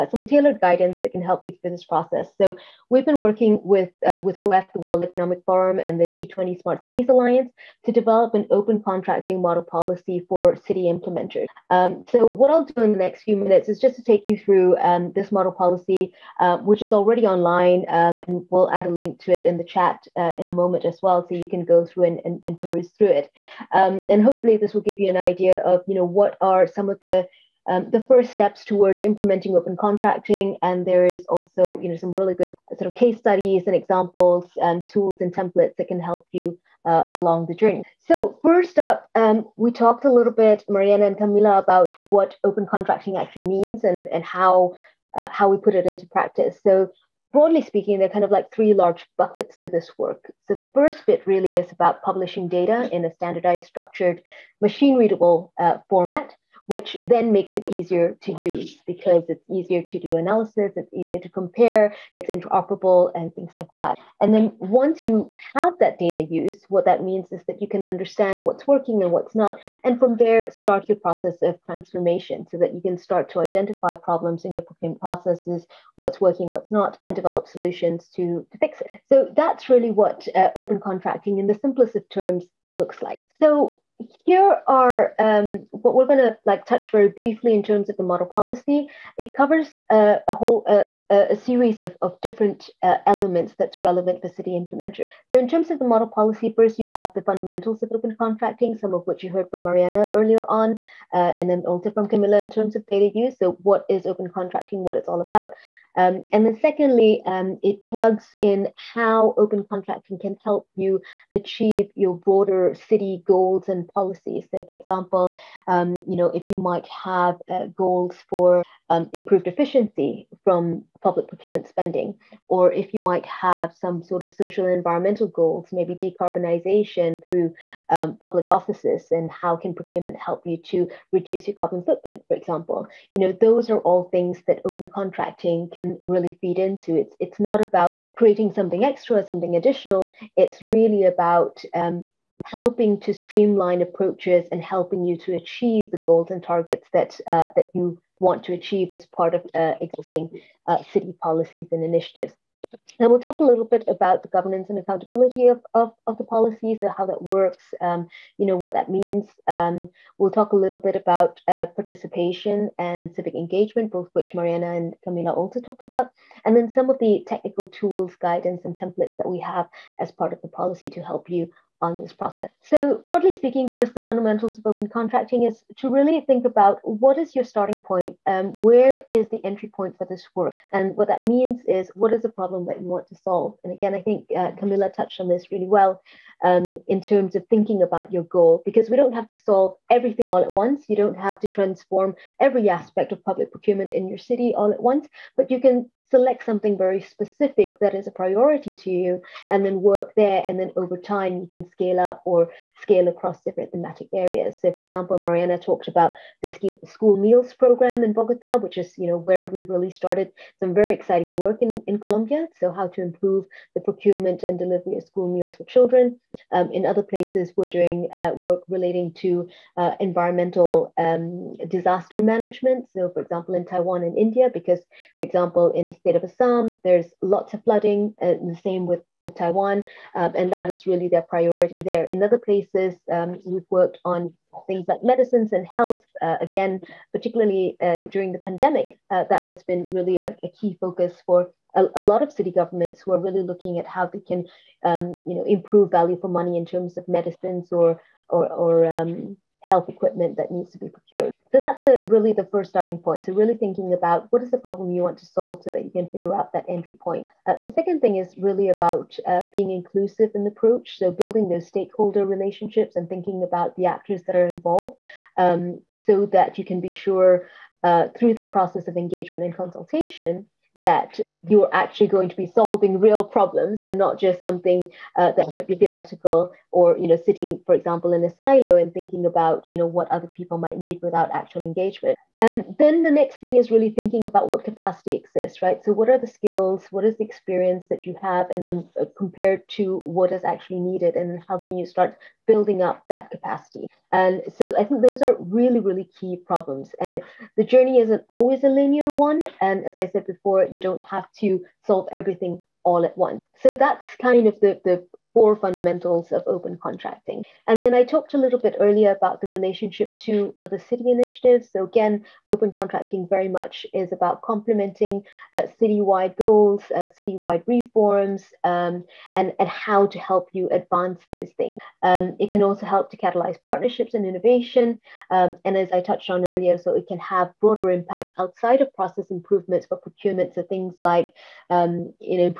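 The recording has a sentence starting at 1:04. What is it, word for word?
And then once you have that data use, what that means is that you can understand what's working and what's not.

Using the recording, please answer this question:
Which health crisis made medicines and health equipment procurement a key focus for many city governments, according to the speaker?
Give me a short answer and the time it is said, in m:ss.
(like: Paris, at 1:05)
the pandemic, at 3:58.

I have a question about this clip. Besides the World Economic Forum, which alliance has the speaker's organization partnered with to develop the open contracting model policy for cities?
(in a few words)
G20 Smart Cities Alliance.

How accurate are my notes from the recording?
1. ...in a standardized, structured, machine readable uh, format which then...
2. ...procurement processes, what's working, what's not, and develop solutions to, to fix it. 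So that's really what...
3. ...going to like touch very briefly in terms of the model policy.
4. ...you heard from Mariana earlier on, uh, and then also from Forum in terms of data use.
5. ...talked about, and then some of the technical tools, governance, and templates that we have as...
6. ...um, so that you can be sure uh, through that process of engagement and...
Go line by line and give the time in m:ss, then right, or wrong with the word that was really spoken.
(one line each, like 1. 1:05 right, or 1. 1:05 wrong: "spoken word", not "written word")
1. 0:52 right
2. 1:14 right
3. 1:26 right
4. 1:39 wrong: "Camila", not "Forum"
5. 2:45 wrong: "guidance", not "governance"
6. 4:25 right.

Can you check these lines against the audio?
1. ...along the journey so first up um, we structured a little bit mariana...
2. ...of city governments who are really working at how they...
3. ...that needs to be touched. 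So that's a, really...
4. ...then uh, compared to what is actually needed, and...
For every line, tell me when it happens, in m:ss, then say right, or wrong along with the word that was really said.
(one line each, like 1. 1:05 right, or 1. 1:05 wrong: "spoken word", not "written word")
1. 0:37 wrong: "talked", not "structured"
2. 4:02 wrong: "looking", not "working"
3. 4:10 wrong: "procured", not "touched"
4. 4:48 right.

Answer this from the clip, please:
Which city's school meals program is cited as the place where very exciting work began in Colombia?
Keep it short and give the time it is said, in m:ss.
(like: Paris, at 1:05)
Bogota, at 3:28.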